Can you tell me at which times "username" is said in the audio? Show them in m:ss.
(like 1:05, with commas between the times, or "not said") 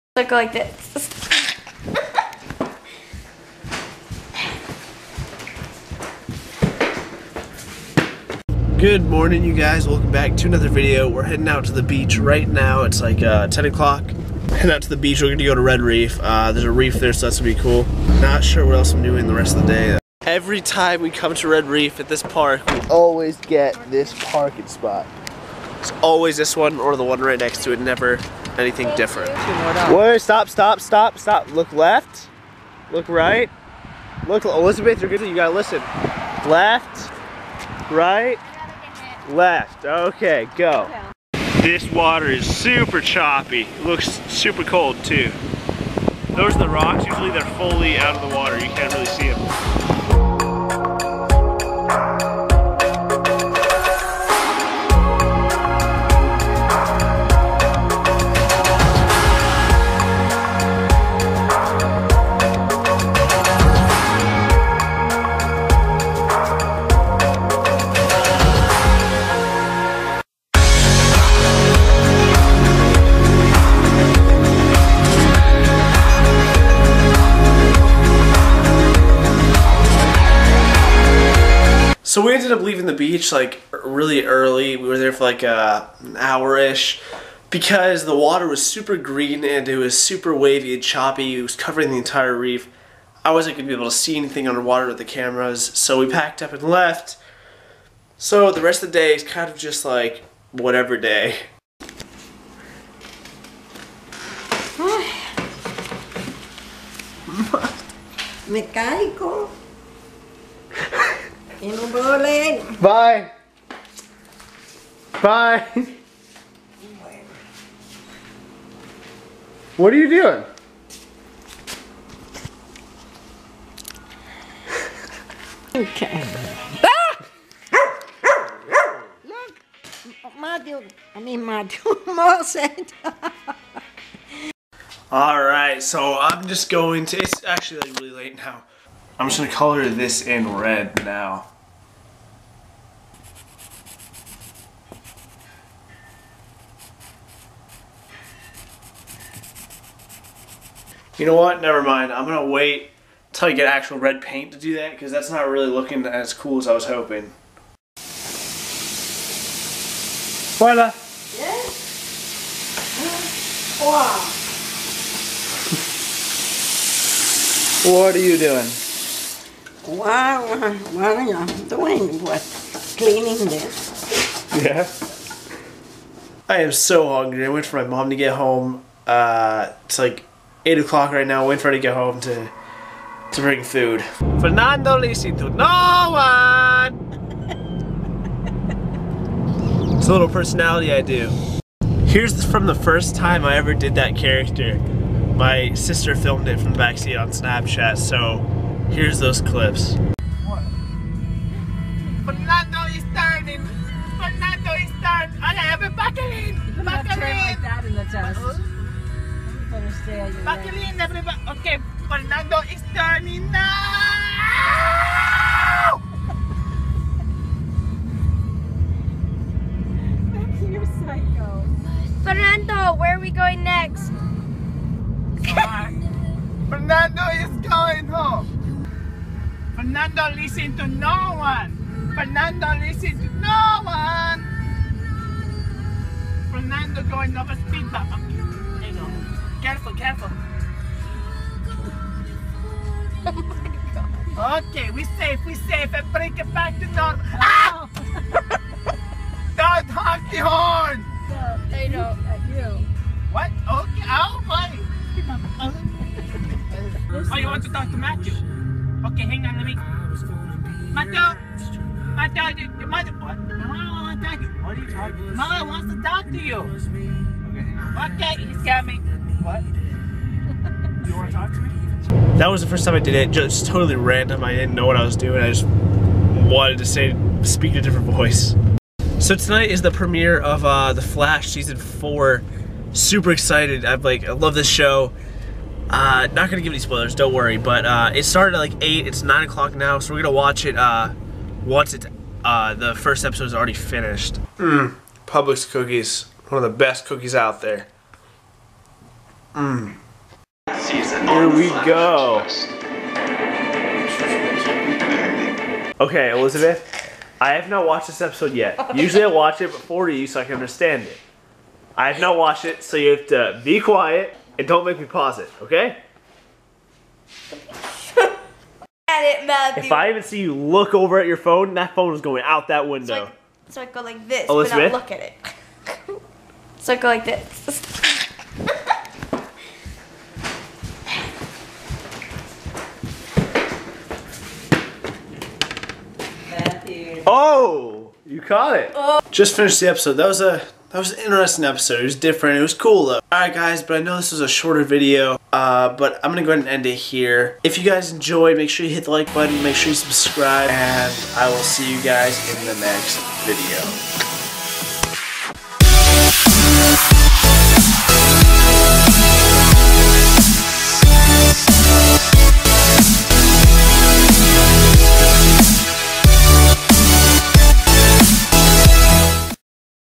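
not said.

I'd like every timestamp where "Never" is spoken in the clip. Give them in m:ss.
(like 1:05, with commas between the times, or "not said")
0:27, 2:31.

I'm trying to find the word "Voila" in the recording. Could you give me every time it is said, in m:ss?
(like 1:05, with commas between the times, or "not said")
2:40.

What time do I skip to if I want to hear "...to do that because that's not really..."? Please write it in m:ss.
2:34.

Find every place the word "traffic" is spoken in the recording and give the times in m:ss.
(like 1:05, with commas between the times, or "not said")
not said.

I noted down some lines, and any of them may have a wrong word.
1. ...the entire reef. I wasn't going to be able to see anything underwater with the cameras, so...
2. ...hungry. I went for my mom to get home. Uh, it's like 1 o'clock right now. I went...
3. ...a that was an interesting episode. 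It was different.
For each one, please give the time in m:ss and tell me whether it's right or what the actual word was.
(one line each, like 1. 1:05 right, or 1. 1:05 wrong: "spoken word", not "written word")
1. 1:31 right
2. 2:57 wrong: "8", not "1"
3. 5:40 right.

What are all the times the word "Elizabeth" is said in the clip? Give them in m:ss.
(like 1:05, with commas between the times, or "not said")
0:34, 5:06, 5:24.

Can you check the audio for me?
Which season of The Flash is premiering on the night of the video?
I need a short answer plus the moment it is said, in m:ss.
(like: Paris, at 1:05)
4, at 4:41.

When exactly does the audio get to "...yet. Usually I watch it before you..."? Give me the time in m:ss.
5:08.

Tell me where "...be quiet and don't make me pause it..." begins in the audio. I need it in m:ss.
5:13.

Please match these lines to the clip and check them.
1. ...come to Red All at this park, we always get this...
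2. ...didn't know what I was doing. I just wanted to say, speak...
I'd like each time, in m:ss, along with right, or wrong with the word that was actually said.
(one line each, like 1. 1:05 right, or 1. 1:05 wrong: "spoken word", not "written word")
1. 0:21 wrong: "Reef", not "All"
2. 4:34 right.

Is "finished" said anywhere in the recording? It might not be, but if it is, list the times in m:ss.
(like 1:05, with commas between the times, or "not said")
4:53, 5:39.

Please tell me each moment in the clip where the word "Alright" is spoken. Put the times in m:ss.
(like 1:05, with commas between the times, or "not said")
5:43.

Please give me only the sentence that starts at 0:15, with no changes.
We're going to go to Red Reef.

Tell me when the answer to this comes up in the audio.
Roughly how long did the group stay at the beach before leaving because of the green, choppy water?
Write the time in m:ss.
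1:26.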